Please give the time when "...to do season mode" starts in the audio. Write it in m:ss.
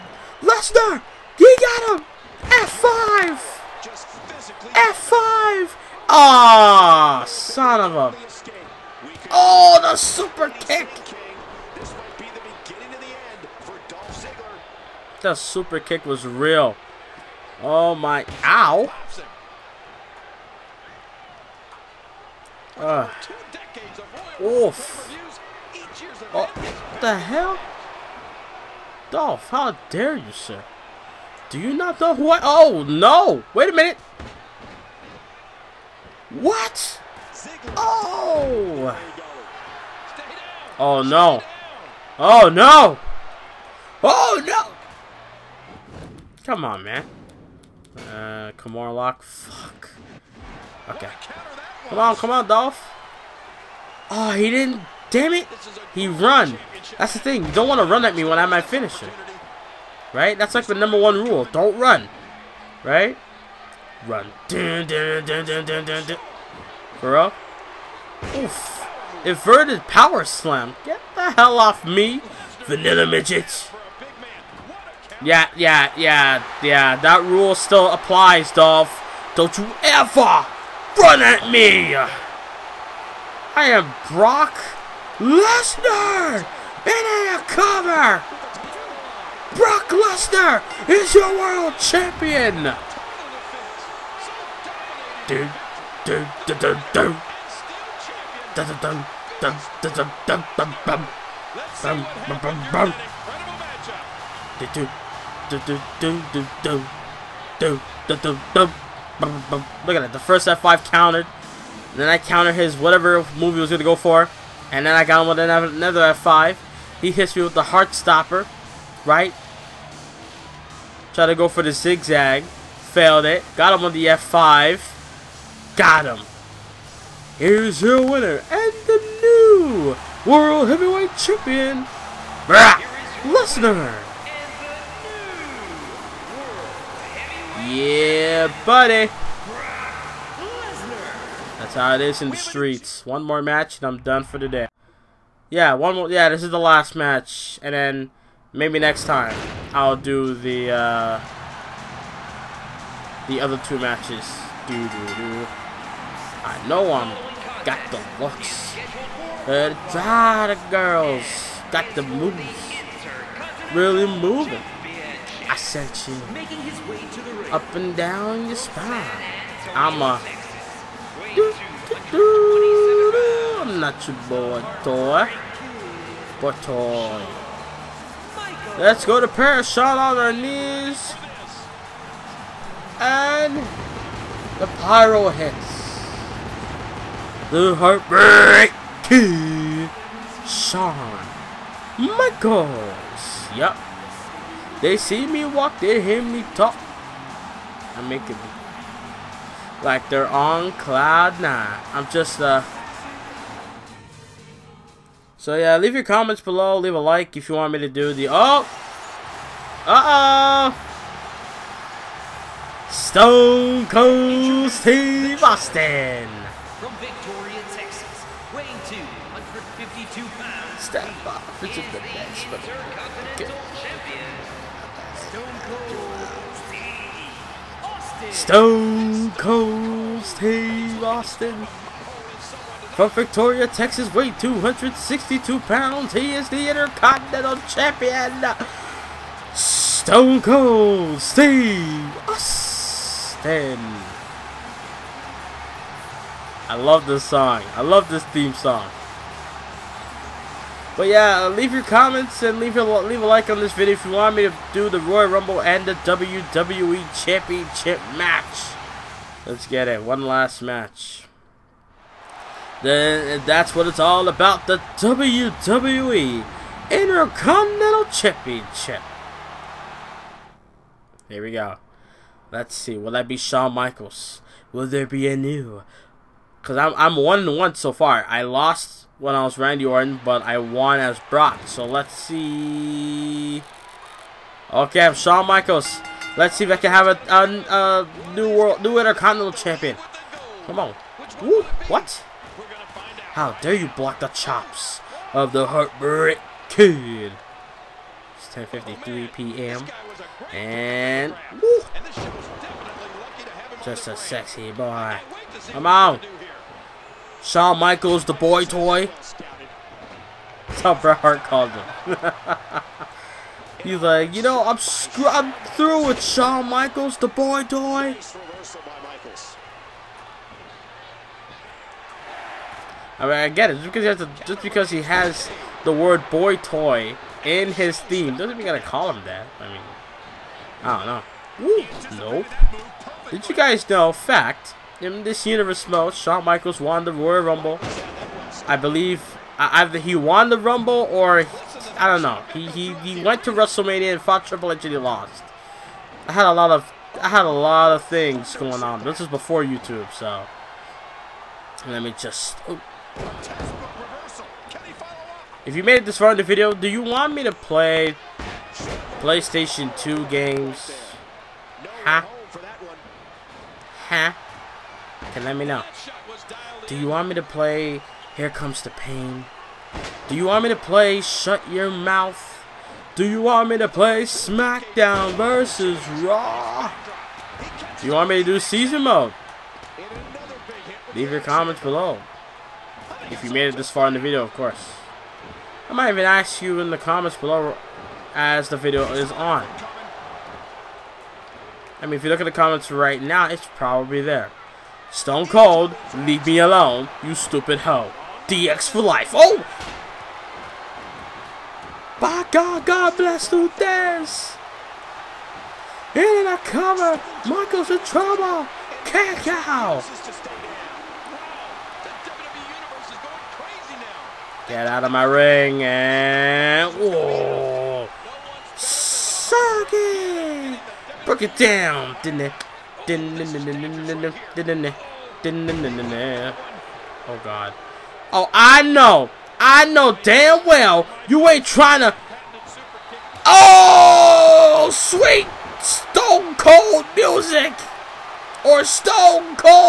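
6:18.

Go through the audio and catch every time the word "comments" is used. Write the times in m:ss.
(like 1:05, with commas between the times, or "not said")
3:26, 4:11, 6:21, 6:26, 6:32.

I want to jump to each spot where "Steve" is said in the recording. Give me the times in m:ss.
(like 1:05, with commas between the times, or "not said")
3:34, 3:50, 4:01.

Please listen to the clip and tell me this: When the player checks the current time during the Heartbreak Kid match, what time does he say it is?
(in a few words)
10:53 p.m.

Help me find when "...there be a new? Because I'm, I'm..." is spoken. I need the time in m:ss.
4:34.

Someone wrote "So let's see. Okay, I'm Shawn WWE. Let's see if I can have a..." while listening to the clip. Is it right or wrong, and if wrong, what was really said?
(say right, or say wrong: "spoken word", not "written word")
wrong: "Michaels", not "WWE".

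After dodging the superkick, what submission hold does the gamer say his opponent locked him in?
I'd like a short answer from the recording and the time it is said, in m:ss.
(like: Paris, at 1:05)
Kimura lock, at 0:48.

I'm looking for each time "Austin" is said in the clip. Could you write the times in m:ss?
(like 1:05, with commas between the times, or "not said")
3:35, 3:51, 4:02.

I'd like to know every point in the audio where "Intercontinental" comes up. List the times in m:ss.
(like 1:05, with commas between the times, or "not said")
3:56, 4:26, 4:48.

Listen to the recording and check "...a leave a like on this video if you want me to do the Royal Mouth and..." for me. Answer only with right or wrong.
wrong.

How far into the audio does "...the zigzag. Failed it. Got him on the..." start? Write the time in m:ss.
2:01.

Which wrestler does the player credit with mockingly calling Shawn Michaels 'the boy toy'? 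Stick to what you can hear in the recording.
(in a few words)
Bret Hart.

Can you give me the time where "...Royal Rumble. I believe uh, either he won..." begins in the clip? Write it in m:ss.
5:37.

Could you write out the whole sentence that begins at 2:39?
Uh, the girls got the moves.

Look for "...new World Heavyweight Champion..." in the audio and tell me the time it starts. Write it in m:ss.
2:09.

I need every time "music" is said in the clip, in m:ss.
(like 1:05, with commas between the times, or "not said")
7:17.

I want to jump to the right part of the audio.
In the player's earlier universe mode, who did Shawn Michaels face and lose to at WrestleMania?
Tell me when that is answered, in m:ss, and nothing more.
5:44.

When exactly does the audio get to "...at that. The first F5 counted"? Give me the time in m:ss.
1:49.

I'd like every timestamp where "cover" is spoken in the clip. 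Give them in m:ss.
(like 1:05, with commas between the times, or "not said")
1:27, 6:46.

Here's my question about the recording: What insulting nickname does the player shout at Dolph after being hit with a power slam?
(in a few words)
vanilla midget.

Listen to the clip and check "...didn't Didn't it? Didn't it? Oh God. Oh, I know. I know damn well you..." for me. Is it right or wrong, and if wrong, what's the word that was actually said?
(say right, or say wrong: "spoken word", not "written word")
right.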